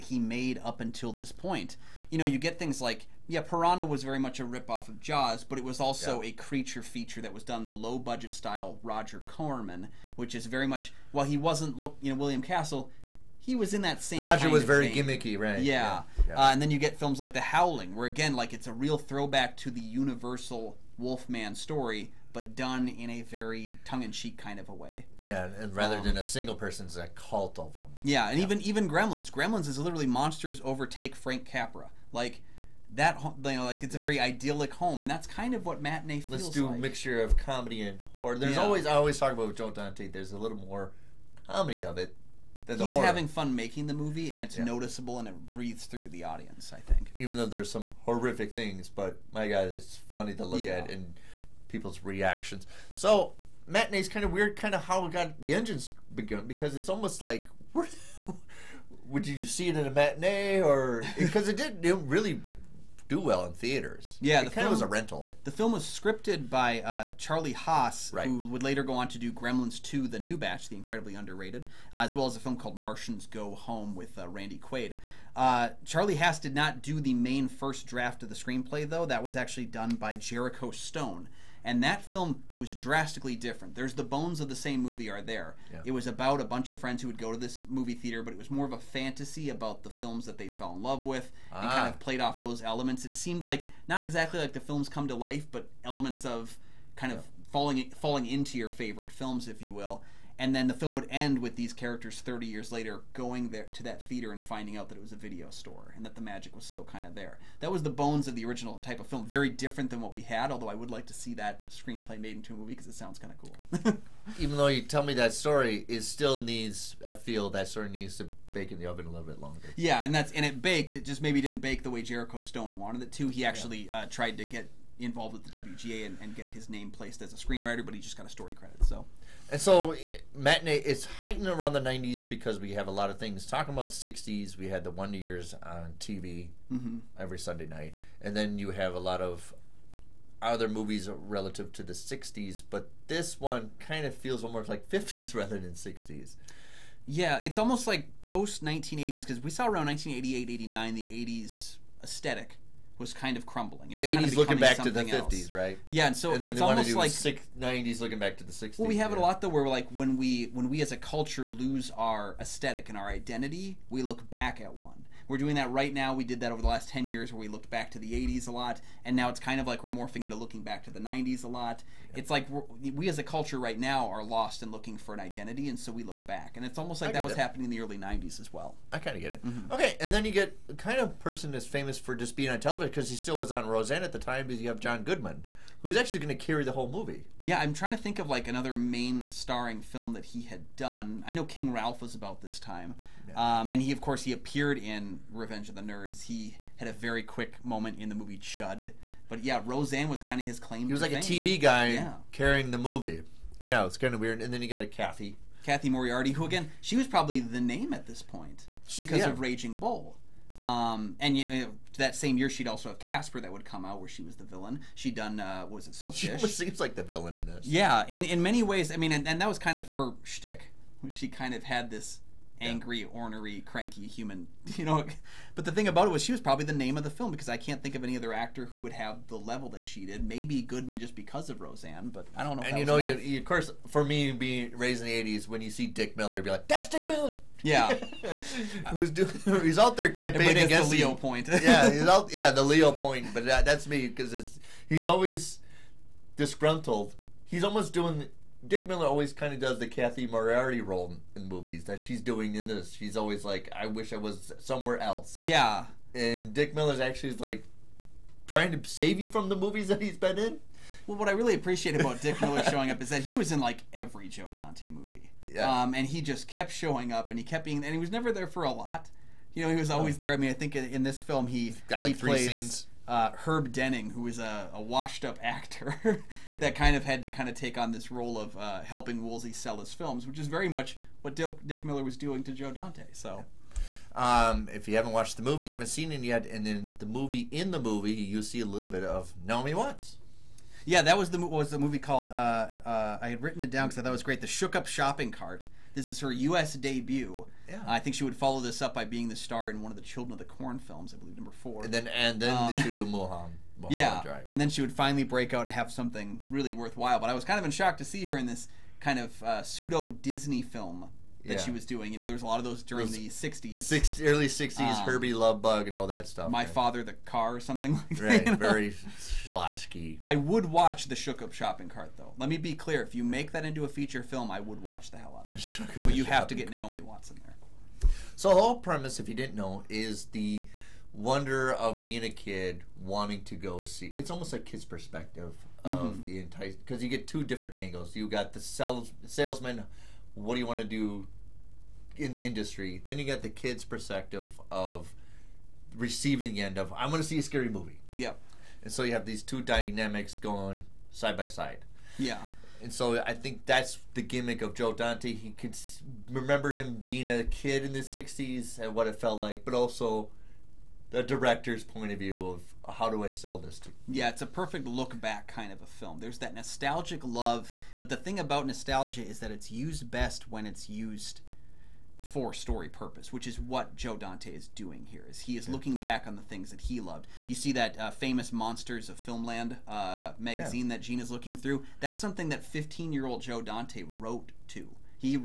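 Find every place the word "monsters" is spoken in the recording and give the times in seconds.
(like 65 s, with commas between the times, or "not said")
30 s, 378 s.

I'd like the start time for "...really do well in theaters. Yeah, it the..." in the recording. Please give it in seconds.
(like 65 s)
61 s.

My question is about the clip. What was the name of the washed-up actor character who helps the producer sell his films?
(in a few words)
Herb Denning.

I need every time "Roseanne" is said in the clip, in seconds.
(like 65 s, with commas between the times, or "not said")
183 s, 199 s, 231 s.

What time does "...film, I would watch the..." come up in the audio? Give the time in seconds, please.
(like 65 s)
324 s.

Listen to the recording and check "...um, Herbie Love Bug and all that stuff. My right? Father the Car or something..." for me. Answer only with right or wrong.
right.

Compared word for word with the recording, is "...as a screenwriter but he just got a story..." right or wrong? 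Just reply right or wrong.
right.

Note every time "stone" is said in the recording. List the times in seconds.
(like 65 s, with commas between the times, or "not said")
80 s, 122 s.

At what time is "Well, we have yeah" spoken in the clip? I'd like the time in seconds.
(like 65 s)
158 s.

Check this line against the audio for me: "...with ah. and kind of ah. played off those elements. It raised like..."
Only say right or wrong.
wrong.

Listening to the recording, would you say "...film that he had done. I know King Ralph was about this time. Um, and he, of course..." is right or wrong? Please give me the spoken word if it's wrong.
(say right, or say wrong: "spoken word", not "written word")
right.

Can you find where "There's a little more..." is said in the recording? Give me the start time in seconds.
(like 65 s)
40 s.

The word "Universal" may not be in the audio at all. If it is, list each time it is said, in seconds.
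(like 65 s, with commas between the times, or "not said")
19 s.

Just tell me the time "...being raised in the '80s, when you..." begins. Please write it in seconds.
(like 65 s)
234 s.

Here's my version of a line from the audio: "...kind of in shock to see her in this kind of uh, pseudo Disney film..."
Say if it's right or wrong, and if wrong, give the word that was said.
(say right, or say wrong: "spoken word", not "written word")
right.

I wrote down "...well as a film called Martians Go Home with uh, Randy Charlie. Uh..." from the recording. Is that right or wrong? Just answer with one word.
wrong.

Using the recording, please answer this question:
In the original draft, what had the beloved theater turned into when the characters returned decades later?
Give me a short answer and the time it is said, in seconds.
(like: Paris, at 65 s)
a video store, at 105 s.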